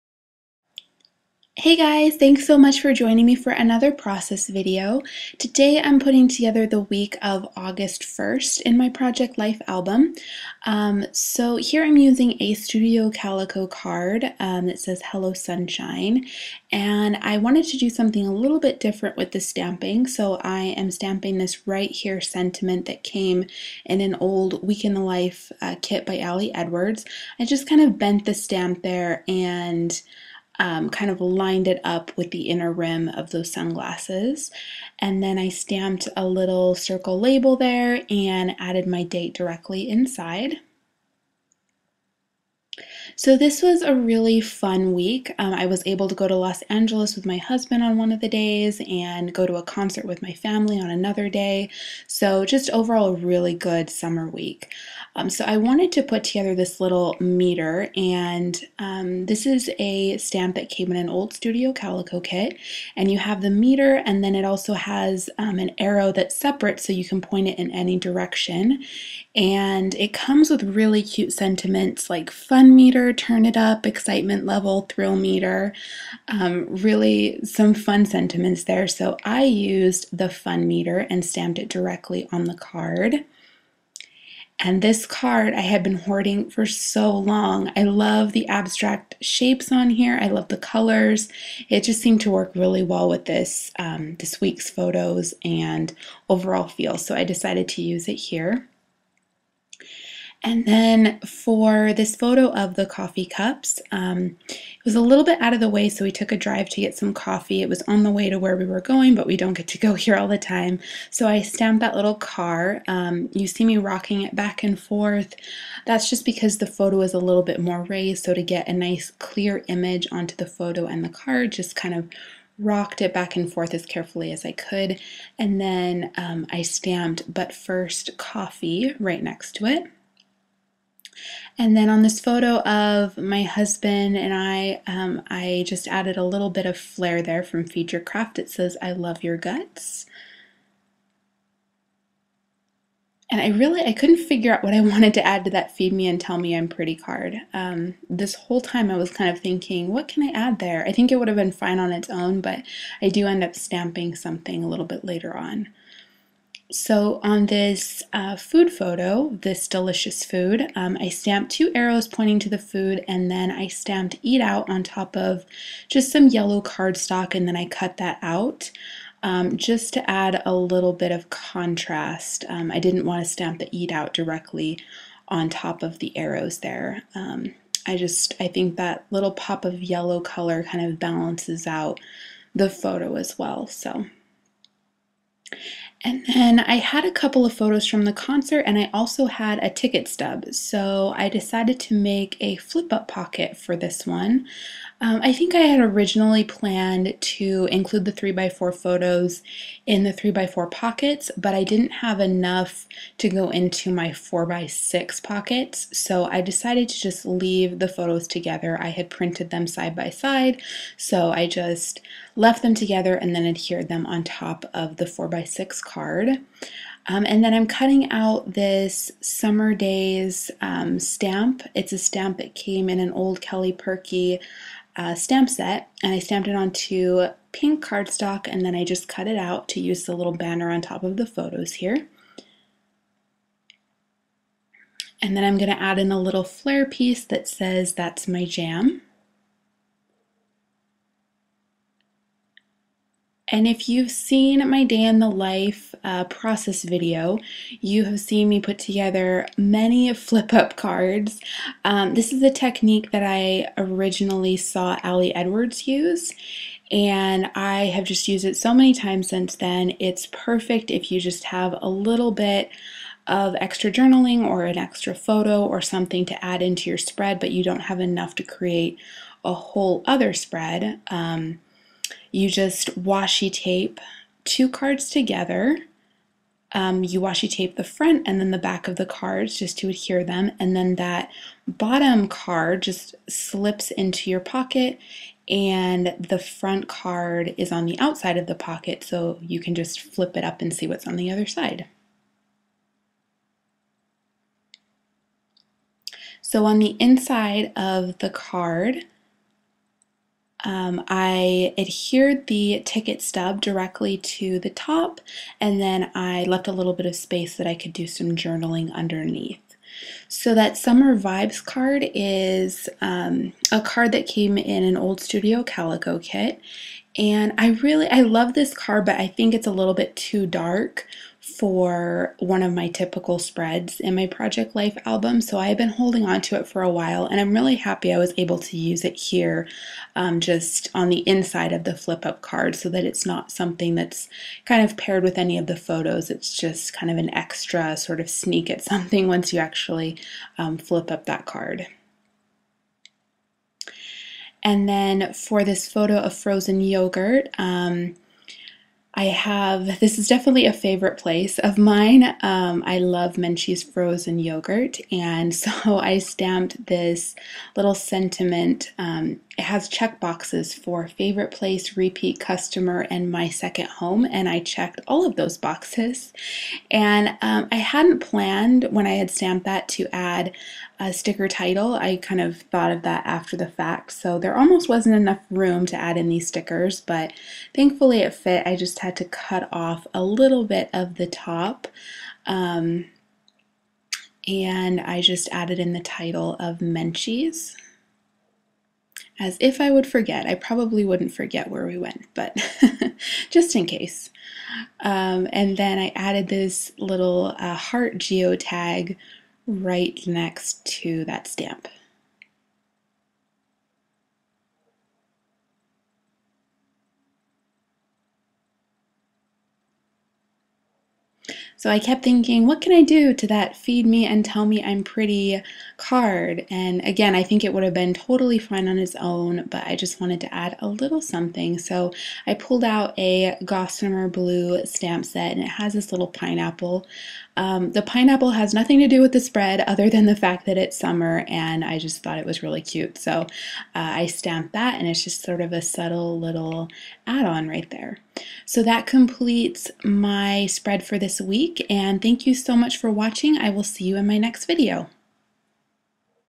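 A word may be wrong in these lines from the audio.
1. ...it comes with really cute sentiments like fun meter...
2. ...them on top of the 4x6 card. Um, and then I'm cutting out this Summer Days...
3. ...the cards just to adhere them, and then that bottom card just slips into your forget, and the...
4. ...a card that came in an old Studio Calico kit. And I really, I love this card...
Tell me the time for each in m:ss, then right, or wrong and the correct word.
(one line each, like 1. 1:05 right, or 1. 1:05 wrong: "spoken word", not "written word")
1. 1:09 right
2. 3:33 right
3. 4:38 wrong: "pocket", not "forget"
4. 5:13 right.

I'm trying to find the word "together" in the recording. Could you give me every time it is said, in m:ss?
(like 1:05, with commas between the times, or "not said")
0:06, 0:56, 3:28, 3:32, 4:08, 4:35.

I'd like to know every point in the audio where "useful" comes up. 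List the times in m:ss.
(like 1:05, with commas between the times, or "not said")
not said.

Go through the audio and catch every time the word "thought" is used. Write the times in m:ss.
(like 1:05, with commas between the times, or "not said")
6:12, 7:12.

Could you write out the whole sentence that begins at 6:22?
Um, and I just added in the title of Menchie's.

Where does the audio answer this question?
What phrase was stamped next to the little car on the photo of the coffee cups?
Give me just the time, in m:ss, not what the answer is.
2:07.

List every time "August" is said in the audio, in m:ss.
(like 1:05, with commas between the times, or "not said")
0:07.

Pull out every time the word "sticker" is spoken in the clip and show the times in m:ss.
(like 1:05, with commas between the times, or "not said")
6:11, 6:16.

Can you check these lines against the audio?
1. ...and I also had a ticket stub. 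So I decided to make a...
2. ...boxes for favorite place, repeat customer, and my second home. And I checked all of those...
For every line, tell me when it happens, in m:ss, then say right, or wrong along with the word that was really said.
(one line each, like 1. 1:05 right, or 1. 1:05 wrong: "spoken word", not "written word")
1. 3:08 right
2. 6:00 right.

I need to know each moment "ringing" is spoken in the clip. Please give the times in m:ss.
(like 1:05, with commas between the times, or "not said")
not said.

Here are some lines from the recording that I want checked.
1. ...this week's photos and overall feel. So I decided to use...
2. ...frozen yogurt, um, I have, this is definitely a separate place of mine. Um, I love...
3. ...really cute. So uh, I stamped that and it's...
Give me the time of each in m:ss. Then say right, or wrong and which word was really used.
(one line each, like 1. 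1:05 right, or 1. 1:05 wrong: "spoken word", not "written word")
1. 1:34 right
2. 5:46 wrong: "favorite", not "separate"
3. 7:12 right.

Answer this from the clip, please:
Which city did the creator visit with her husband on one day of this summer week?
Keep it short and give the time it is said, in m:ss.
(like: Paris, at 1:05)
Los Angeles, at 0:46.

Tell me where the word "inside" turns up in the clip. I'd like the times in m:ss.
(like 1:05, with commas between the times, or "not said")
0:39, 4:56, 5:31.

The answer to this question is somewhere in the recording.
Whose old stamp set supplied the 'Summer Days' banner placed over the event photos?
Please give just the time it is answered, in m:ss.
3:43.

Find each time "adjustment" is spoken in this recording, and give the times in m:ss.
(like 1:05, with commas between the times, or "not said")
not said.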